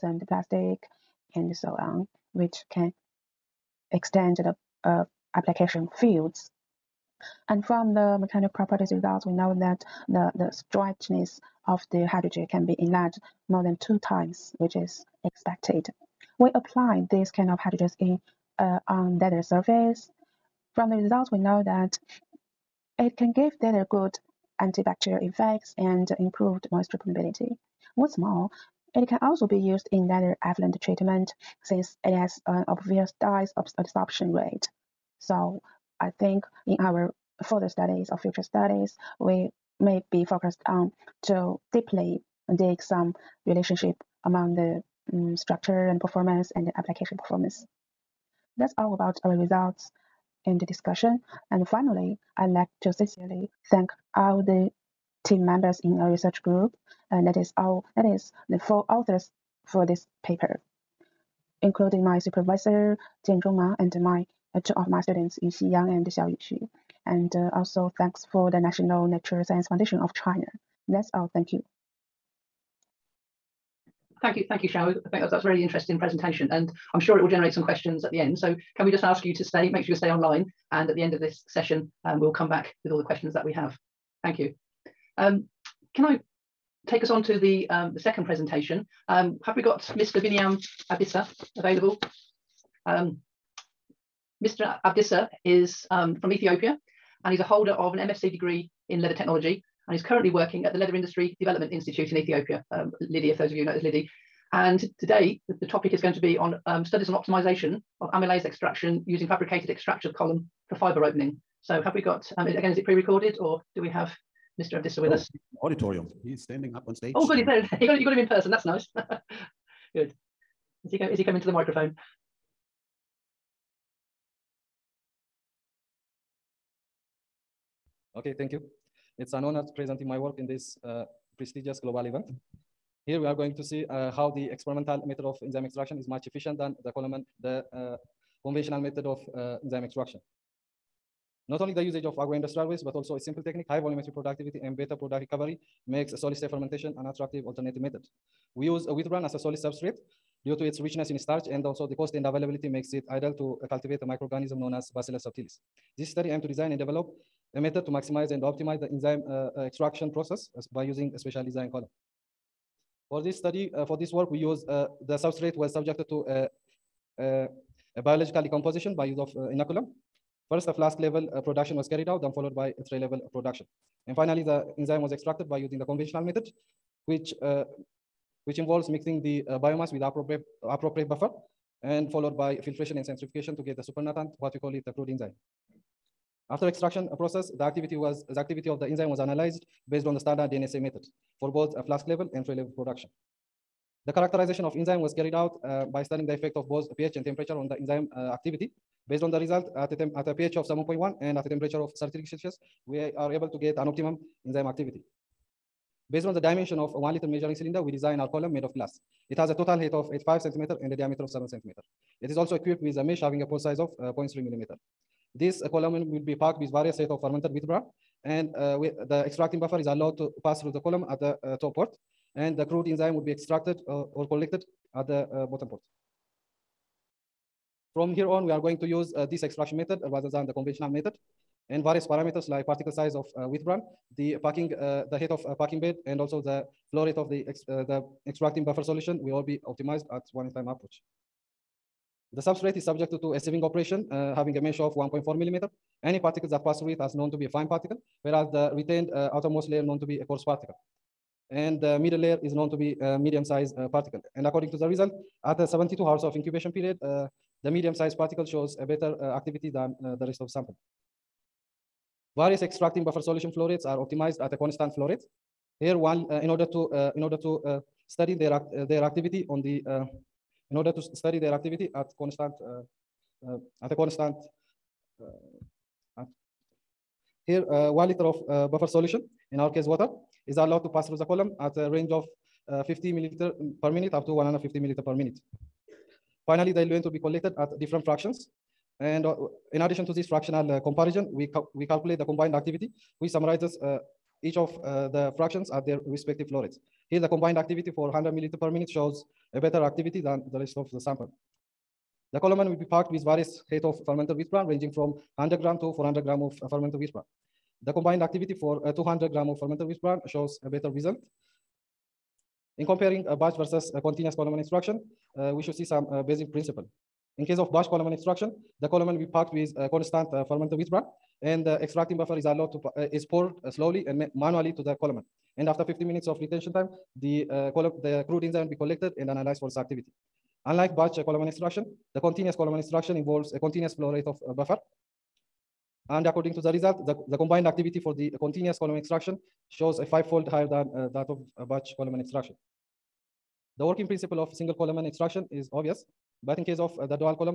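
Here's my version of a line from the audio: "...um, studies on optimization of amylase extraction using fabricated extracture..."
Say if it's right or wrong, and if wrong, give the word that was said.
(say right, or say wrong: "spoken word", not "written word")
right.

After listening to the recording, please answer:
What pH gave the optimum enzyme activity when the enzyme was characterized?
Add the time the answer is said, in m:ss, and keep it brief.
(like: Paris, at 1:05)
7.1, at 3:20.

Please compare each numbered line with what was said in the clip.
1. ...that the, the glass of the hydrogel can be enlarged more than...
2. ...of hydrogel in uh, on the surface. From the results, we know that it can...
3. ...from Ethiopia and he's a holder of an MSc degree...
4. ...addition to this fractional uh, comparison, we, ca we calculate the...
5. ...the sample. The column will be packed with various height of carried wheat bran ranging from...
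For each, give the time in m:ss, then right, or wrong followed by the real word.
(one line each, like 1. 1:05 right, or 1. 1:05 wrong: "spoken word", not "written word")
1. 0:09 wrong: "stretchness", not "glass"
2. 0:17 right
3. 1:36 right
4. 4:49 right
5. 5:00 wrong: "fermented", not "carried".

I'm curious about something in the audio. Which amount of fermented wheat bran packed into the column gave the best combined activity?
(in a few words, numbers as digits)
200 grams.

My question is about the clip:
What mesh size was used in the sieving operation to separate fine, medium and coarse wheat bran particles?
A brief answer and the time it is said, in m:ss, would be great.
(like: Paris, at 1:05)
1.4 millimeters, at 4:04.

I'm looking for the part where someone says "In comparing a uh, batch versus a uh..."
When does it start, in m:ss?
5:12.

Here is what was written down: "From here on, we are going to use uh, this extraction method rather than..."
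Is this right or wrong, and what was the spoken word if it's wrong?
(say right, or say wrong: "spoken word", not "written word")
right.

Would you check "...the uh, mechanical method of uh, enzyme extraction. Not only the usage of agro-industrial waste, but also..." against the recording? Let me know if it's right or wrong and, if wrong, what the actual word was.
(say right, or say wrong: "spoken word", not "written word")
wrong: "conventional", not "mechanical".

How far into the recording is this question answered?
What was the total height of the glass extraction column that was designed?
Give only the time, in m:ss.
3:30.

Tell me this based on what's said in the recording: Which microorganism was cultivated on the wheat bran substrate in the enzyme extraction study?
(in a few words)
Bacillus subtilis.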